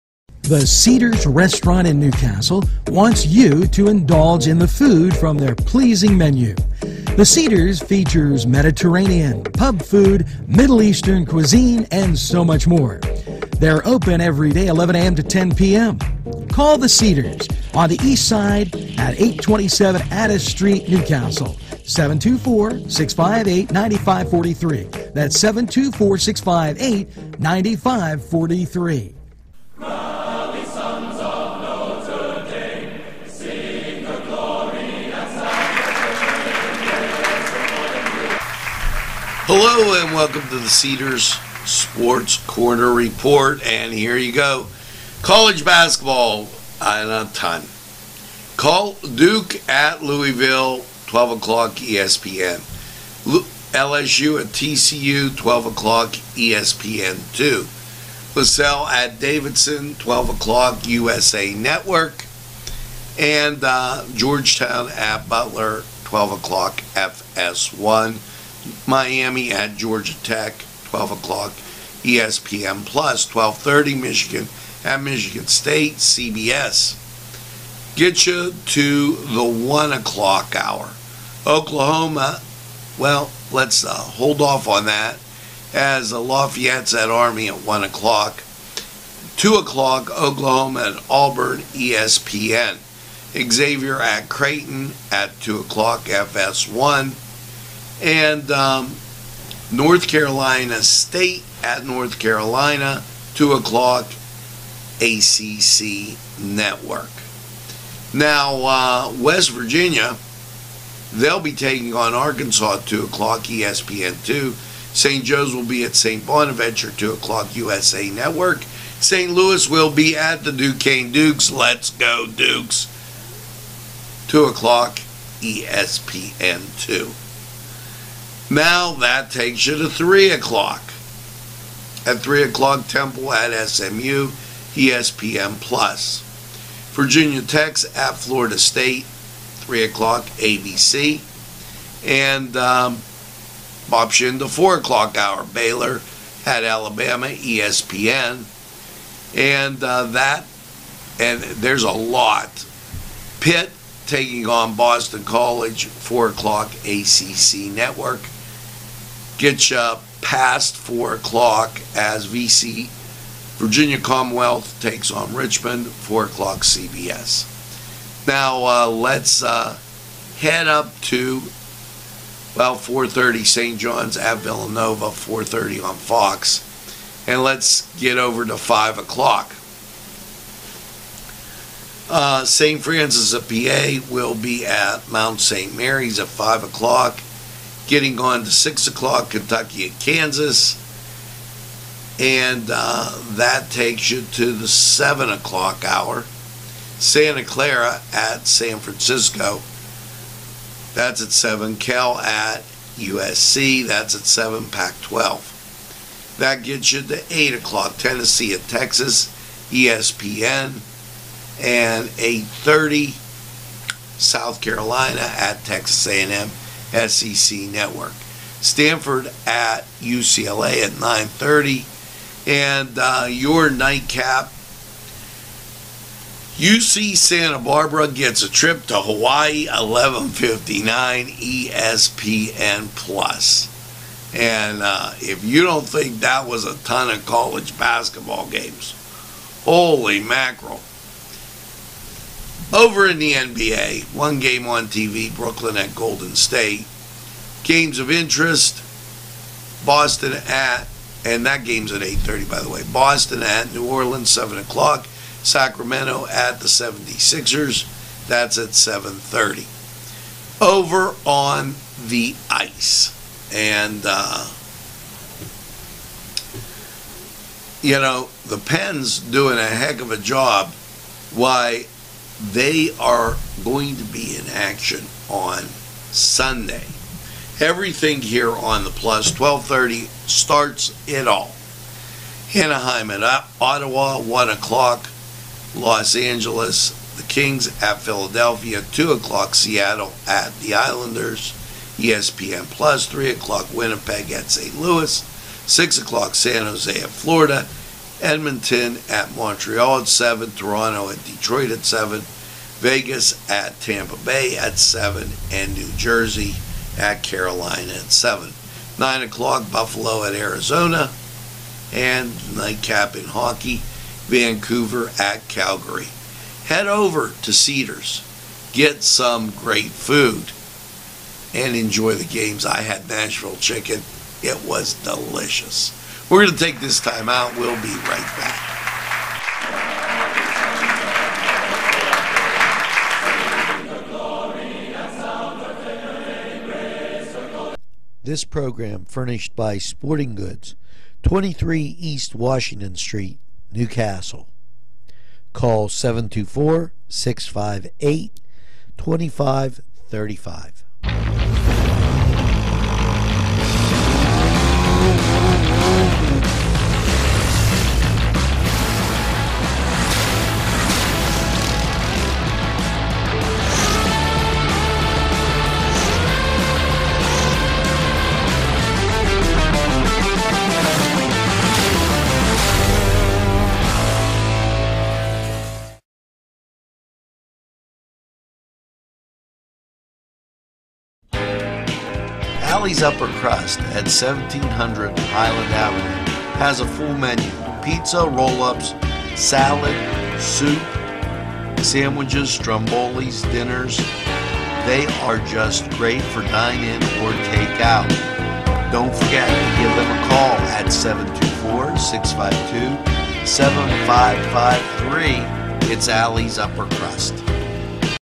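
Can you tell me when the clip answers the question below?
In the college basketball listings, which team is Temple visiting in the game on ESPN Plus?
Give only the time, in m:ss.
2:13.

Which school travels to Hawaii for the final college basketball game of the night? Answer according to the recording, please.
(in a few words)
UC Santa Barbara.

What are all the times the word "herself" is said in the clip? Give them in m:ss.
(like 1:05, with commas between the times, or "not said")
not said.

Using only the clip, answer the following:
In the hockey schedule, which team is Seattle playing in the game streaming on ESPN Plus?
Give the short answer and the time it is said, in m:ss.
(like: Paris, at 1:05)
the Islanders, at 4:50.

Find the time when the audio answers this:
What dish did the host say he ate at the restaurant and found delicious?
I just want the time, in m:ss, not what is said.
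5:23.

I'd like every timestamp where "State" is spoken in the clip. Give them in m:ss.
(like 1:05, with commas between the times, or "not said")
1:15, 1:40, 2:18, 4:06.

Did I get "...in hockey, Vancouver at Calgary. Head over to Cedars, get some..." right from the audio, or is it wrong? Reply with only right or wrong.
right.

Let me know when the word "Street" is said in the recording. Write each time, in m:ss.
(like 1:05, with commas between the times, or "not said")
0:20, 5:42.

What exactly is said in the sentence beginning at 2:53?
John's at Villanova, 4.30 on Fox.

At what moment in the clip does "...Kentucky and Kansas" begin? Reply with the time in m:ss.
3:09.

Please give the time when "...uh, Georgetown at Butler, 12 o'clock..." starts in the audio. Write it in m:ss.
1:03.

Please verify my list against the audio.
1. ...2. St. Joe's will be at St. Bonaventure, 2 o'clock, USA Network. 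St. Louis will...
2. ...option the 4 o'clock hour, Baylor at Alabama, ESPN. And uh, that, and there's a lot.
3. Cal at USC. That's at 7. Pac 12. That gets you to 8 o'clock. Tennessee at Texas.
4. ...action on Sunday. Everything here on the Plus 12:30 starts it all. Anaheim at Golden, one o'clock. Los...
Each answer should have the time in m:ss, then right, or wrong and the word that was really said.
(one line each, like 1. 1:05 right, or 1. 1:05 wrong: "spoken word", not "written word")
1. 1:54 right
2. 2:23 right
3. 3:21 right
4. 4:34 wrong: "Ottawa", not "Golden".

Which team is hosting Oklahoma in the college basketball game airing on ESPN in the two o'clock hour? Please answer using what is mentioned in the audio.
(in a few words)
Auburn.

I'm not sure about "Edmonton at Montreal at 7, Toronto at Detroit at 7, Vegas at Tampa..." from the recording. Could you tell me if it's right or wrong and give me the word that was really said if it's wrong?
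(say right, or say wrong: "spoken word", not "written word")
right.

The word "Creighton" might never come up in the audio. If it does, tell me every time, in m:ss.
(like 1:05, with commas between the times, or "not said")
1:34.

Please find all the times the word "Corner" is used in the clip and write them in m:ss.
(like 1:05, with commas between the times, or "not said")
0:42.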